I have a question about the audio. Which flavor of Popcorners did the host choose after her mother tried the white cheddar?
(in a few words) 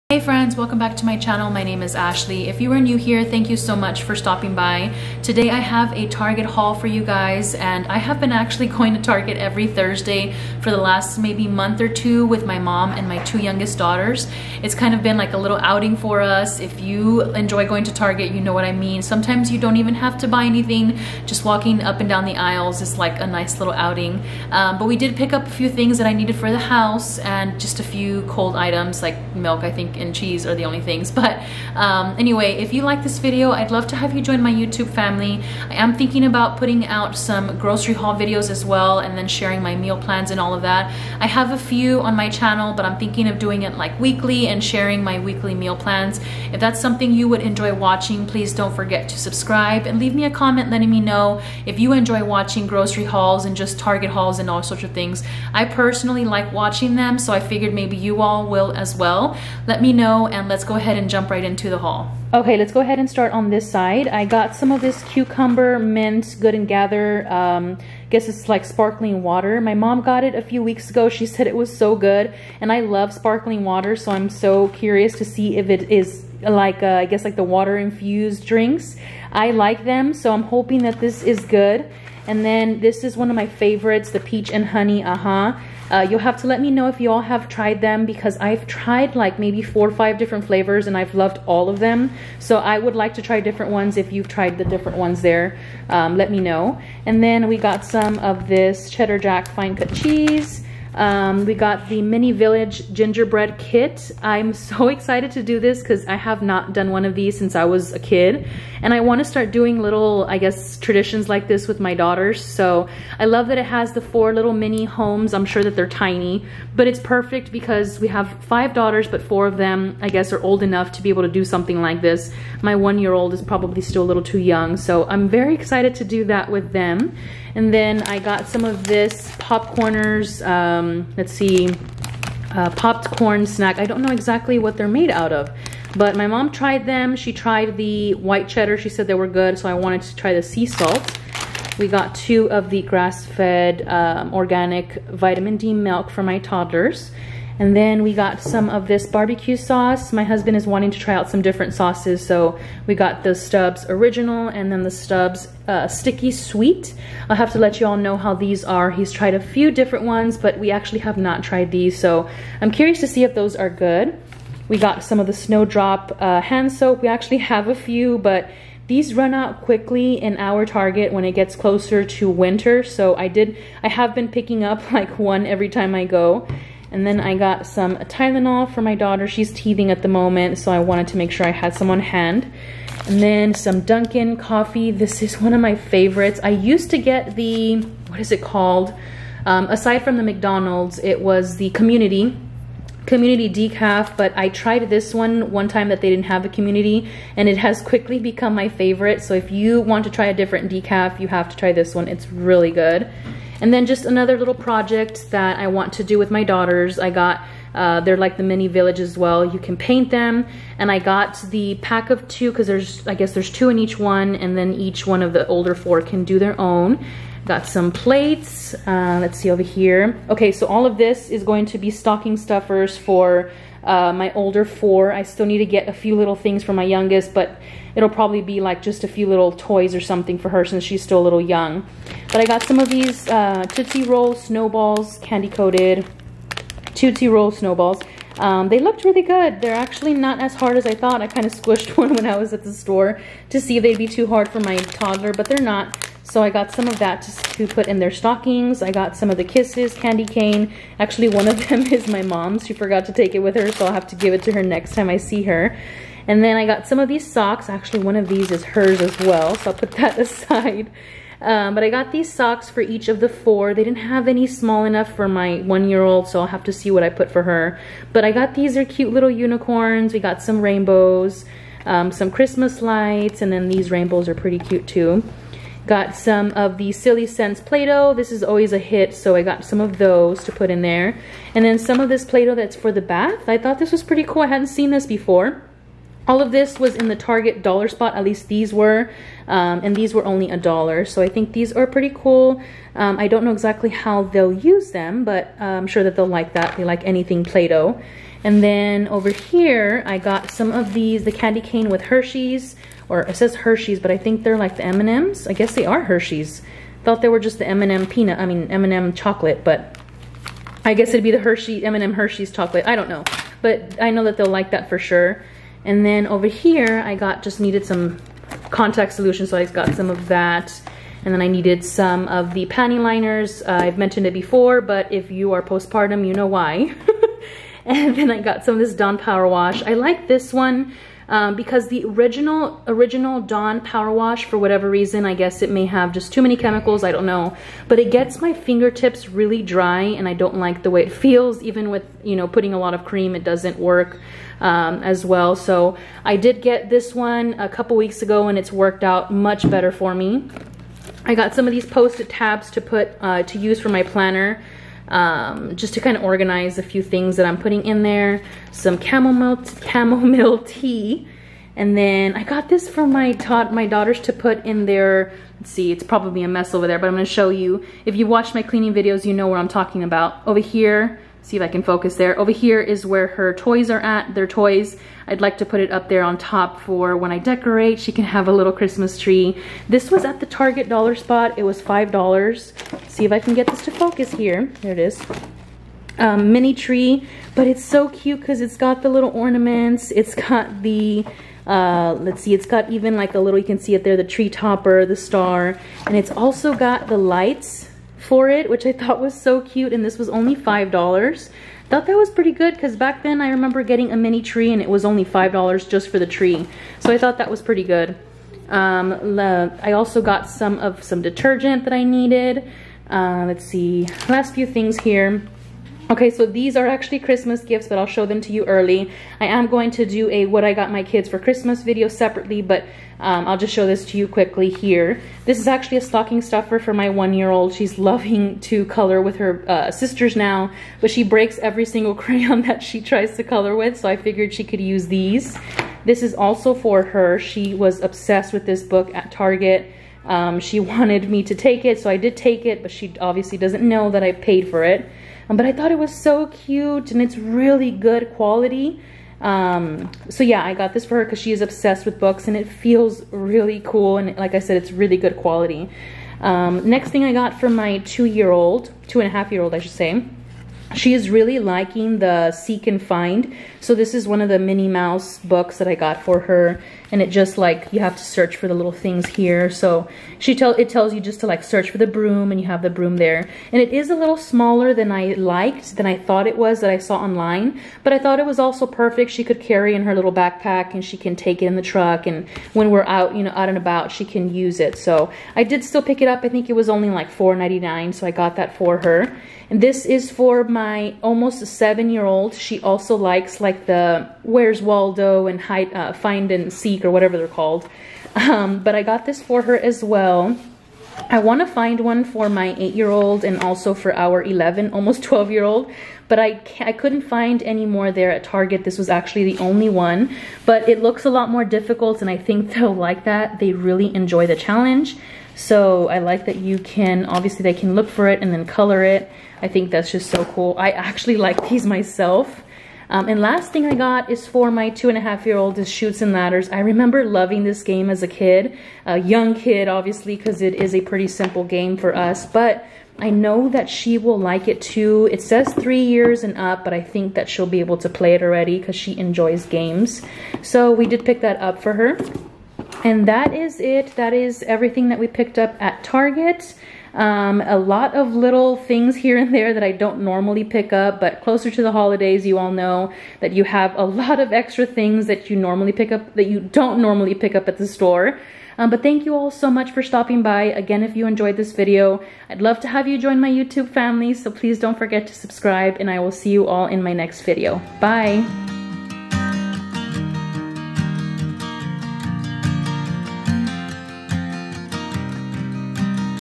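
Sea salt.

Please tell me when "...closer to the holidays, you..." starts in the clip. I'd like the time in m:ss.
9:11.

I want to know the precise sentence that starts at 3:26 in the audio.
I got uh, they're like the mini village as well.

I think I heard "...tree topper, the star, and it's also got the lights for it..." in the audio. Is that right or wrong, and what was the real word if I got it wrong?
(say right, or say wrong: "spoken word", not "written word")
right.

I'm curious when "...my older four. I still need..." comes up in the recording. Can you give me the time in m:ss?
3:44.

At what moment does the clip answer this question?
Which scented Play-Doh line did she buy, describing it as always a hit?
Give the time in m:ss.
4:36.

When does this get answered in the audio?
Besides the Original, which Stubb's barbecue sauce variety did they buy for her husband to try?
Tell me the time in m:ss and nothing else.
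2:35.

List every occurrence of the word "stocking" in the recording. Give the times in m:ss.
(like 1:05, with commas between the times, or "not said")
3:41, 4:08, 7:06.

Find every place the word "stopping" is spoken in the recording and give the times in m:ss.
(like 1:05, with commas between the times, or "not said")
0:04, 9:20.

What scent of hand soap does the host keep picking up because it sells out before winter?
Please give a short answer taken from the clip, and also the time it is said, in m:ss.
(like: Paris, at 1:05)
Snowdrop, at 2:45.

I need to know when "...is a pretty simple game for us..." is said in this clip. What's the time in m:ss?
8:50.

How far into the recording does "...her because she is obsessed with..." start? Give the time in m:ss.
7:31.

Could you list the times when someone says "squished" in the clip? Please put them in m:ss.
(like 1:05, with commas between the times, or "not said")
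4:01.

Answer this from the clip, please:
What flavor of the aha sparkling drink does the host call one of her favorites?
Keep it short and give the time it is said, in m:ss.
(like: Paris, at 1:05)
Peach and honey, at 1:24.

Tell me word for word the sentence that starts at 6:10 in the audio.
Over here, see if I can focus there.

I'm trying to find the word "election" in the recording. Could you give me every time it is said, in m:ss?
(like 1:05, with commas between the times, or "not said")
not said.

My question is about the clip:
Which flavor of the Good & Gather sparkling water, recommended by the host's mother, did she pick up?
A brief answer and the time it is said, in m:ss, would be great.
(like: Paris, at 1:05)
Cucumber mint, at 1:05.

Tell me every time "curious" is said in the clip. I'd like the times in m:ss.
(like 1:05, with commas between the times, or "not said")
1:14, 2:42.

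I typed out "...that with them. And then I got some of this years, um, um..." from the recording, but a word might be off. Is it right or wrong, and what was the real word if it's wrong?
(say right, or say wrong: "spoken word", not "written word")
wrong: "popcorners", not "years".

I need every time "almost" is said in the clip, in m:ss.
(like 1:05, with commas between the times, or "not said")
8:11, 8:24.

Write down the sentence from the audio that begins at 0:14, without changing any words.
It's kind of been like a little outing for us.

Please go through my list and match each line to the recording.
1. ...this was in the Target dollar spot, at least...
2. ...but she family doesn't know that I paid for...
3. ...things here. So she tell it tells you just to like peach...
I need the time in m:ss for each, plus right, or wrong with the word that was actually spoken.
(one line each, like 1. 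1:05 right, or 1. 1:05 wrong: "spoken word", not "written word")
1. 4:46 right
2. 7:22 wrong: "obviously", not "family"
3. 7:48 wrong: "search", not "peach".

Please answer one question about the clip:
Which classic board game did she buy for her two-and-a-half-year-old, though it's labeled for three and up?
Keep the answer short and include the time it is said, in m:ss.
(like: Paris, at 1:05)
Chutes and Ladders, at 8:45.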